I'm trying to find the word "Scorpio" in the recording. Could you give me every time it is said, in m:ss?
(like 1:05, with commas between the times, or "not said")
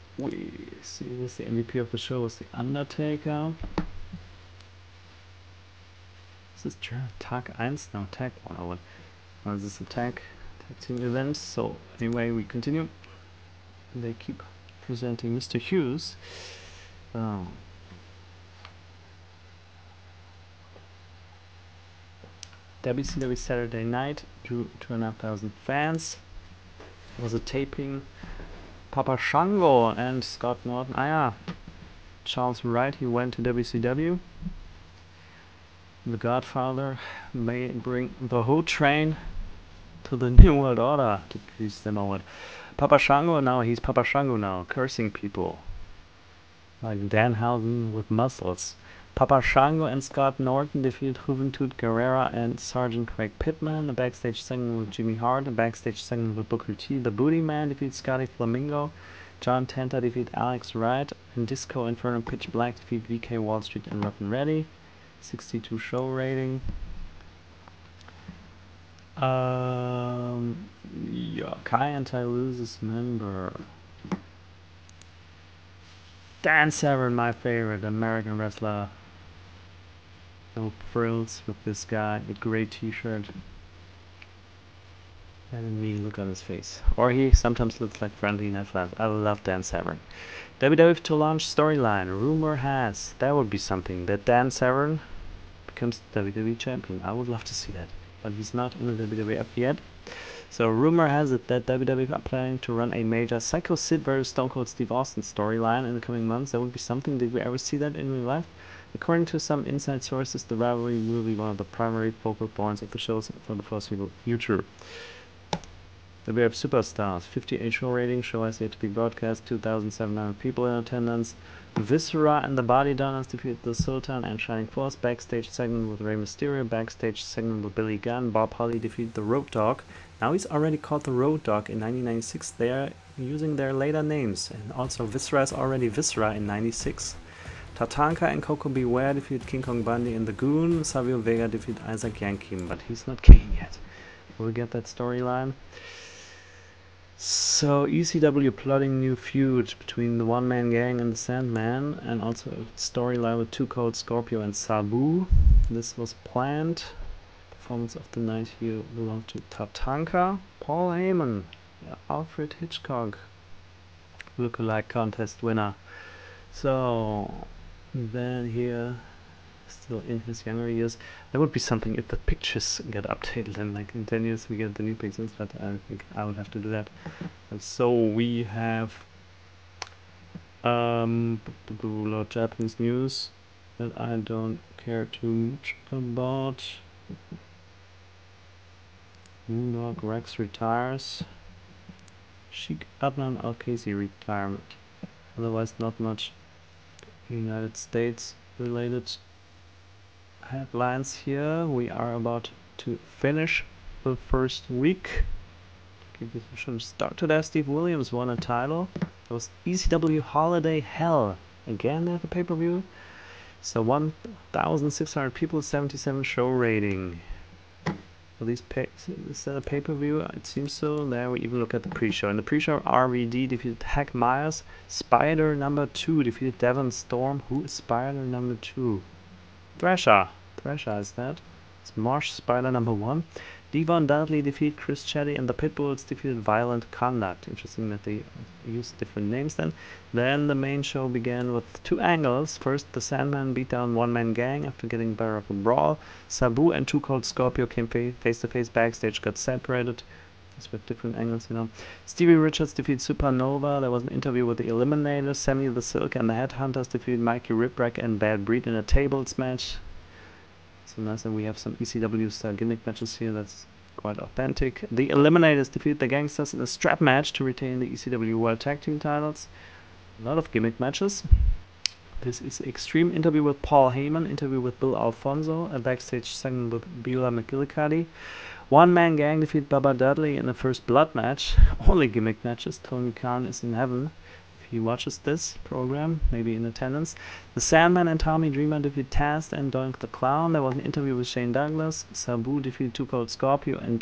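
2:33, 4:07, 4:53.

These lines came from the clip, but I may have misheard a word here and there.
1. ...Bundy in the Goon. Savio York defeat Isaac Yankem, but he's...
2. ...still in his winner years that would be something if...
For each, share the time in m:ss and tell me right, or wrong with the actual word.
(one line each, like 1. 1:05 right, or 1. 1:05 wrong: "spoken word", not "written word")
1. 2:19 wrong: "Vega", not "York"
2. 2:49 wrong: "younger", not "winner".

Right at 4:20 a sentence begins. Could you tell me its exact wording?
So nice that we have some ECW style gimmick matches here.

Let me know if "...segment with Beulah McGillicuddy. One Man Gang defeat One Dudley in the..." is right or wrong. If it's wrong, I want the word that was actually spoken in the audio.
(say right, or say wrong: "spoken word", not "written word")
wrong: "Bubba", not "One".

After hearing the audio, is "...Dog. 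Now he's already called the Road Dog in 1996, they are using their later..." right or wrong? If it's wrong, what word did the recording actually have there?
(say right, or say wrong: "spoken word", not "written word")
right.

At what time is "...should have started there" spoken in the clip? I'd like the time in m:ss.
3:26.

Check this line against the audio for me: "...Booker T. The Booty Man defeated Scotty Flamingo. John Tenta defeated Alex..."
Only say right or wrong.
right.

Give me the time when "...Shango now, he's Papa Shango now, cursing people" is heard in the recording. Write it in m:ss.
0:42.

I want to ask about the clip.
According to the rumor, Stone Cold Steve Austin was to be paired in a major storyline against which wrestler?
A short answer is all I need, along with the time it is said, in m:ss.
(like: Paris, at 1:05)
Psycho Sid, at 1:43.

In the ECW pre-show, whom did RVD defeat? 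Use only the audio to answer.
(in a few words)
Hack Meyers.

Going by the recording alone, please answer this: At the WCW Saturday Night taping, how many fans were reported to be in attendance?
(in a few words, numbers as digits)
2,500.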